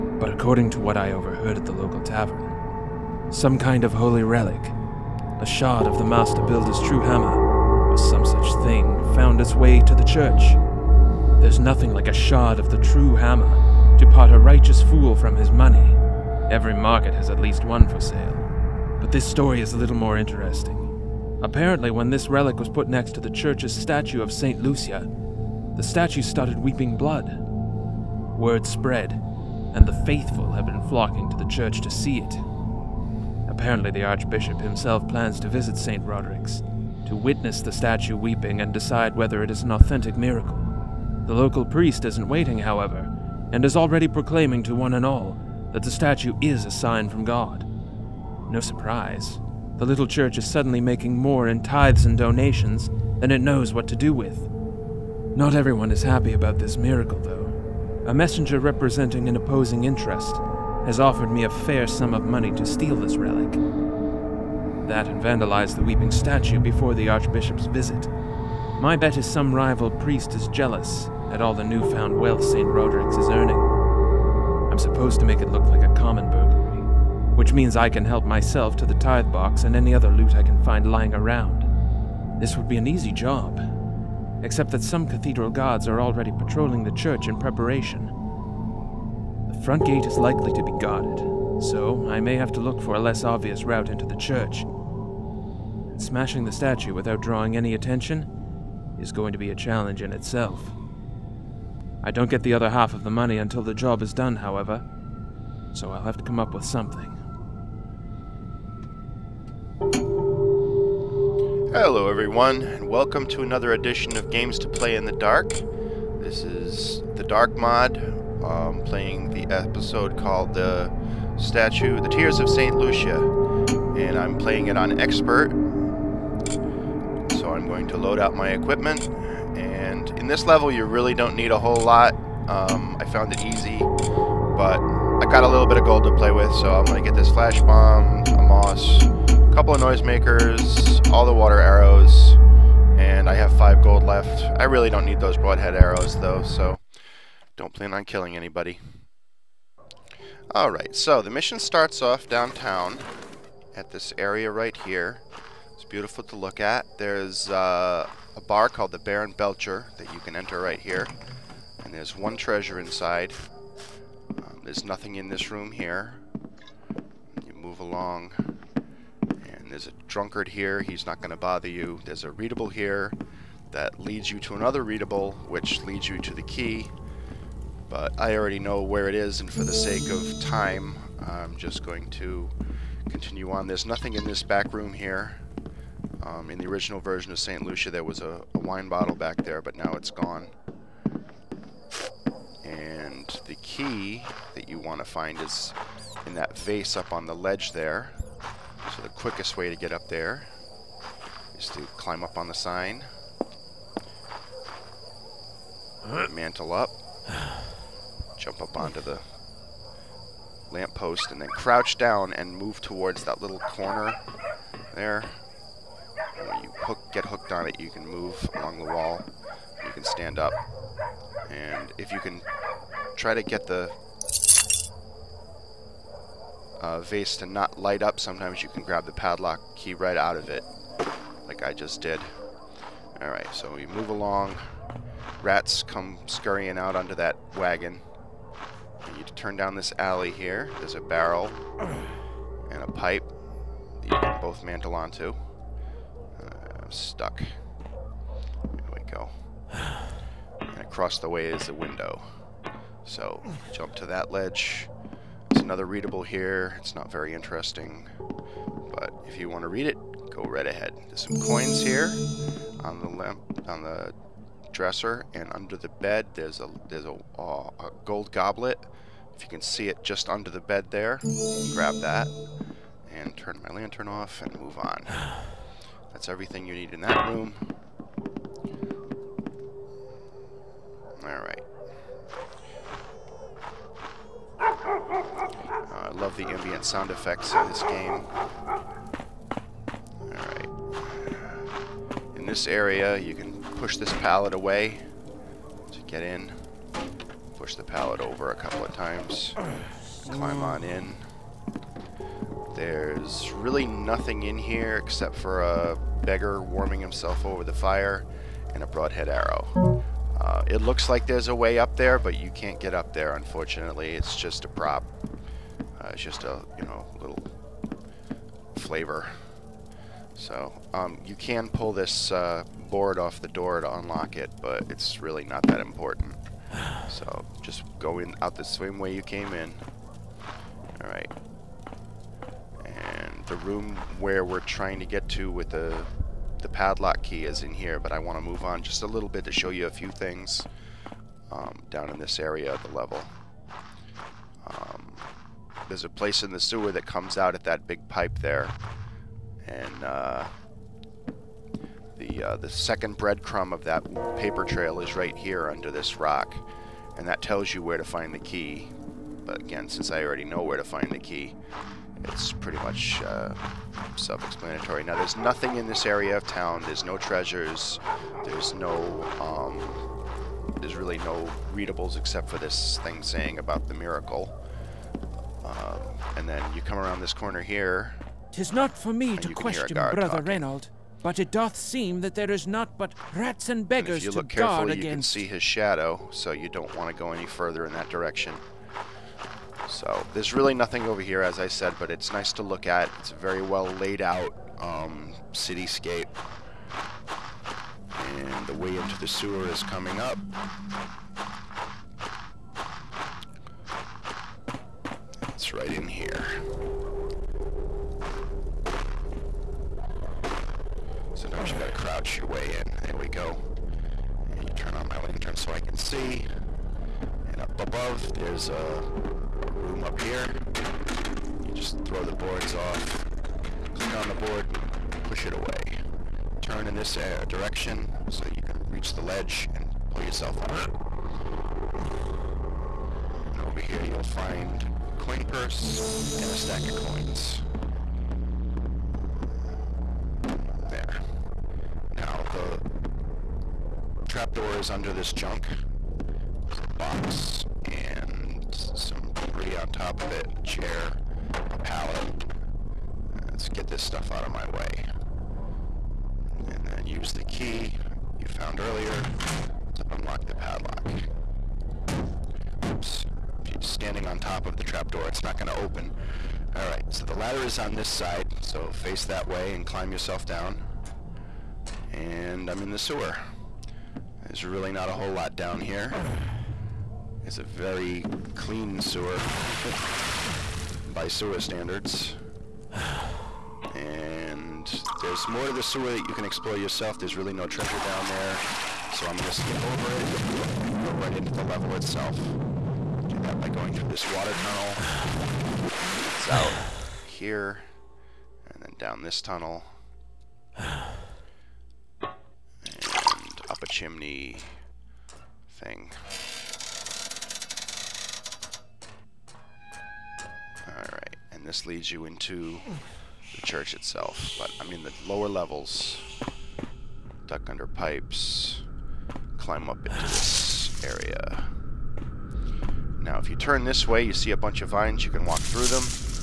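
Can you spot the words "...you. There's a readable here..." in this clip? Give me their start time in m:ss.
2:51.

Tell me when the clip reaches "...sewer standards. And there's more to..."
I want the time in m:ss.
8:01.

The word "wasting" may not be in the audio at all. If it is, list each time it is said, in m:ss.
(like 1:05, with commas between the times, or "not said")
not said.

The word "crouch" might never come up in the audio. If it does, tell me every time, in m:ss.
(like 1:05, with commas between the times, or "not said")
3:31, 6:51.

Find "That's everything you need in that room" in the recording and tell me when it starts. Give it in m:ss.
4:36.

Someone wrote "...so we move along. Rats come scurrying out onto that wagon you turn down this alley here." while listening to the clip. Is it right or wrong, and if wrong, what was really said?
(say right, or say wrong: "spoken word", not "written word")
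right.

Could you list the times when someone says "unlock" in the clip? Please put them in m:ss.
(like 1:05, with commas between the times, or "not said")
5:23, 7:40.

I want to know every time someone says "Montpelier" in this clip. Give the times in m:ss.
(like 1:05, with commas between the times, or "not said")
not said.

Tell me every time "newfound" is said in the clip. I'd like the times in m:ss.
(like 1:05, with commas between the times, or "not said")
1:11.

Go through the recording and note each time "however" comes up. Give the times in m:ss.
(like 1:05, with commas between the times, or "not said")
0:42, 1:44.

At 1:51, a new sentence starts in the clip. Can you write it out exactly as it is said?
Hello, everyone, and welcome to another edition of Games to Play in the Dark.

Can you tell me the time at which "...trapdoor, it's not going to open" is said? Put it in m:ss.
7:44.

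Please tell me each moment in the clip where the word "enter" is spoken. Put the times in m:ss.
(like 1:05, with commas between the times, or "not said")
2:40.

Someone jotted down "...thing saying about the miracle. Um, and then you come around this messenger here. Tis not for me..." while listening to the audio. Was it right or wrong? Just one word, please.
wrong.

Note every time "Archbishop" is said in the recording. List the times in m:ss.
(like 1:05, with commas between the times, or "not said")
0:34, 1:07.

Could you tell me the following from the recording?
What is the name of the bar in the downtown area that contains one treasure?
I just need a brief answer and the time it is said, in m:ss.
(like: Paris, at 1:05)
Baron Belcher, at 2:38.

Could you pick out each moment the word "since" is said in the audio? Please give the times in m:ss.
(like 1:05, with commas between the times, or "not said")
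5:59.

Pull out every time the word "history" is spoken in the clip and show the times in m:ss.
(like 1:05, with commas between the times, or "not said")
not said.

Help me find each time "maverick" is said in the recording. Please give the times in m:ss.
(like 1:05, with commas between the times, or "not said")
not said.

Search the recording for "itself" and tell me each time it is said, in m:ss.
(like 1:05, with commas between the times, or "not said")
1:40, 8:11, 8:33.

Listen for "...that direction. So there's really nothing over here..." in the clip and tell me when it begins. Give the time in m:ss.
6:27.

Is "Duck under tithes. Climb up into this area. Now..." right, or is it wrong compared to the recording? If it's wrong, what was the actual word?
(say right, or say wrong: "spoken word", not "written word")
wrong: "pipes", not "tithes".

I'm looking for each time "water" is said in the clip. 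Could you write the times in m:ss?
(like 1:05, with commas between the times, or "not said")
2:21, 8:14.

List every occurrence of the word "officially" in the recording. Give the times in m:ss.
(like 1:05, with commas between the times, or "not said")
not said.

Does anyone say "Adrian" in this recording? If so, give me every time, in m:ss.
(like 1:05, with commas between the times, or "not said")
not said.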